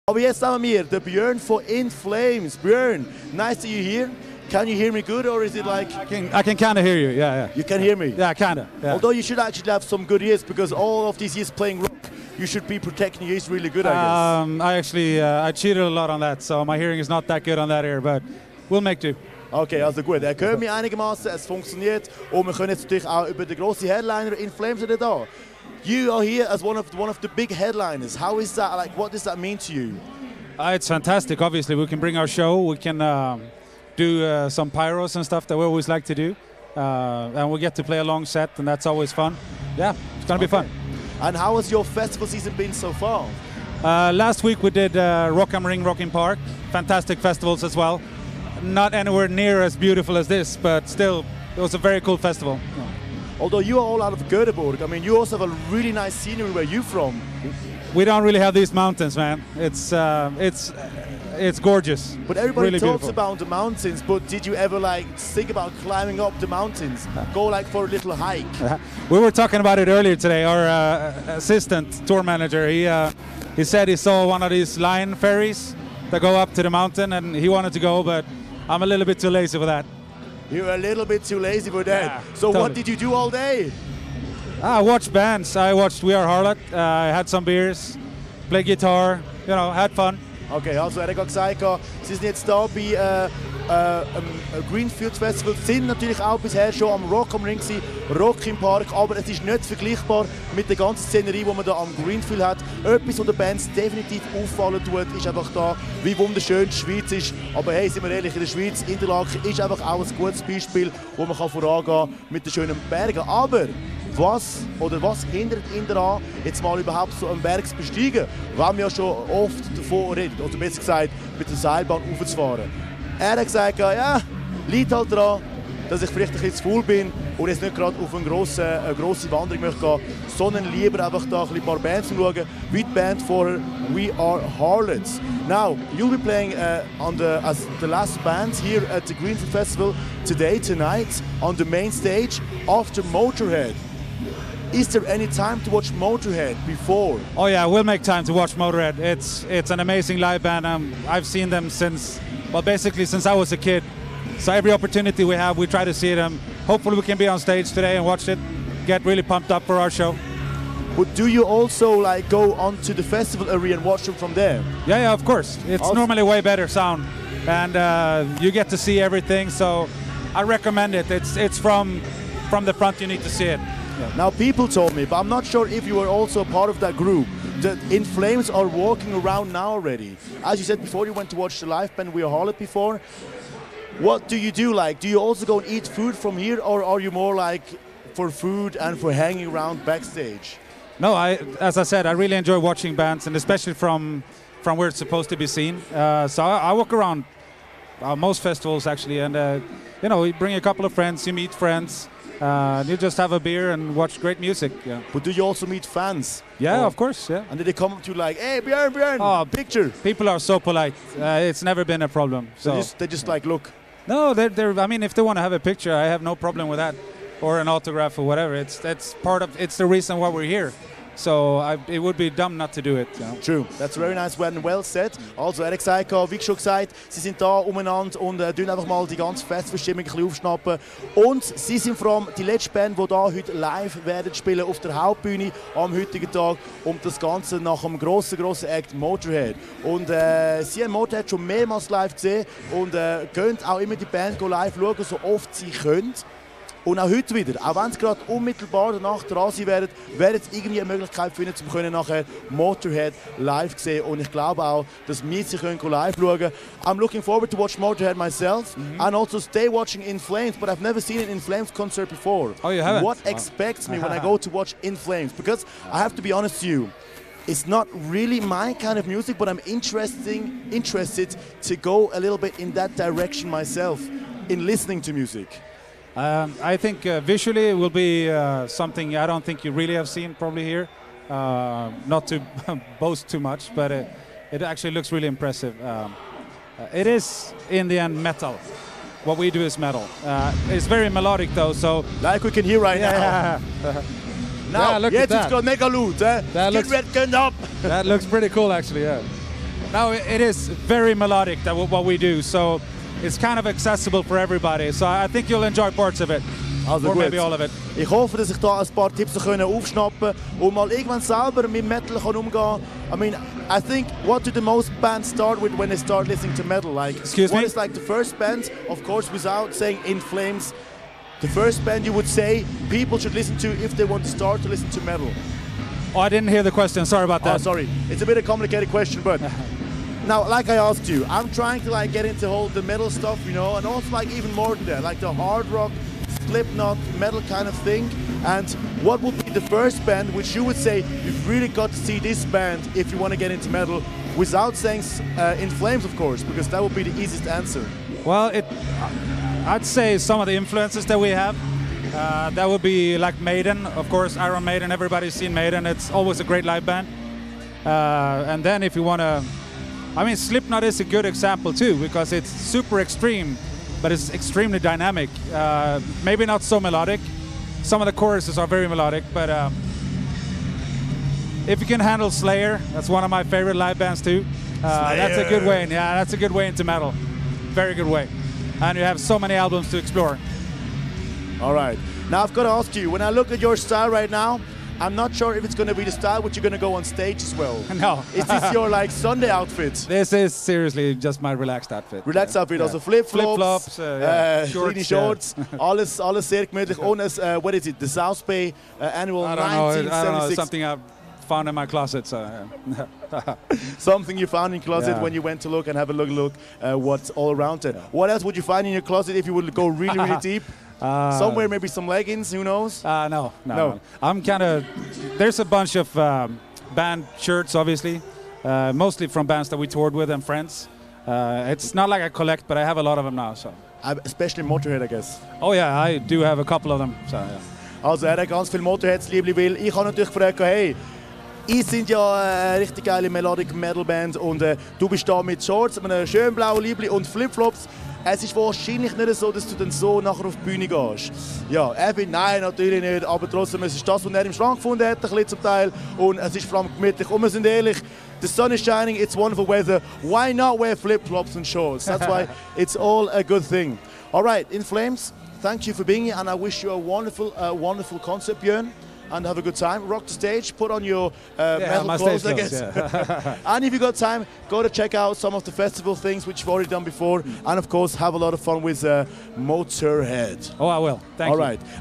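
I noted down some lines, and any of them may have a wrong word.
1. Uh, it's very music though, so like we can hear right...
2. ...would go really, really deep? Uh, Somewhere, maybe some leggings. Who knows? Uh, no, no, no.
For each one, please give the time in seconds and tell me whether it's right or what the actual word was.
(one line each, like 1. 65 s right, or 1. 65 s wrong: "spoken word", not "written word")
1. 290 s wrong: "melodic", not "music"
2. 409 s right.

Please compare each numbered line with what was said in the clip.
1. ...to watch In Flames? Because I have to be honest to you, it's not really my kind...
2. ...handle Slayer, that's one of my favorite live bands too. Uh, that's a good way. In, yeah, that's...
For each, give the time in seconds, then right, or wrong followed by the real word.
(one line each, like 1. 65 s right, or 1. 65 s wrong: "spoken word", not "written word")
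1. 264 s right
2. 372 s right.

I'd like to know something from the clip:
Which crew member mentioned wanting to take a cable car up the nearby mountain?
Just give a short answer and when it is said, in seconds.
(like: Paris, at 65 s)
Assistant tour manager, at 71 s.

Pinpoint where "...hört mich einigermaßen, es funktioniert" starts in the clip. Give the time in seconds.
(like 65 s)
20 s.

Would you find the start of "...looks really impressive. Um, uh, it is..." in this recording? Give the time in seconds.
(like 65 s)
284 s.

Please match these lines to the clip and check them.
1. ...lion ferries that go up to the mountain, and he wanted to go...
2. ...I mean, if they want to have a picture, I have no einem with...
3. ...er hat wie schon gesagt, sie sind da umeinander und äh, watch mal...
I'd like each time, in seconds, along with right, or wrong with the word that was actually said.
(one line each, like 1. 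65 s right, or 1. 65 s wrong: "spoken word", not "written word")
1. 74 s right
2. 214 s wrong: "problem", not "einem"
3. 225 s wrong: "einfach", not "watch".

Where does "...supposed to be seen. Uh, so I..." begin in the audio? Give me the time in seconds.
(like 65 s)
194 s.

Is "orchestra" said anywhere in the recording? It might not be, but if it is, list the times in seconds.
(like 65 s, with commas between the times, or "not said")
not said.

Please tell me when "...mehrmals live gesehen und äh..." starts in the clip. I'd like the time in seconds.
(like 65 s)
241 s.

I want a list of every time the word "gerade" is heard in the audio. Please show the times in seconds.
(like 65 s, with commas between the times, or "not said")
127 s, 247 s.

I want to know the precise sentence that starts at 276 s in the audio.
Um, I think uh, visually it will be uh, something I don't think you really have seen probably here.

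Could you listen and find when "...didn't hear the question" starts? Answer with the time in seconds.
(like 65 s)
326 s.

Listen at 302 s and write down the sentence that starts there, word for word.
So it's kind of accessible for everybody.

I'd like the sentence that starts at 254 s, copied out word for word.
Und ich glaube auch, dass wir sie können live schauen können.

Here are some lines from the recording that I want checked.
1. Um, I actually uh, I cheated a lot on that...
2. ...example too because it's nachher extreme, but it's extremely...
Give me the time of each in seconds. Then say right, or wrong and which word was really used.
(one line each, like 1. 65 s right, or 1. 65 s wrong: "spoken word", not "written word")
1. 14 s right
2. 361 s wrong: "super", not "nachher".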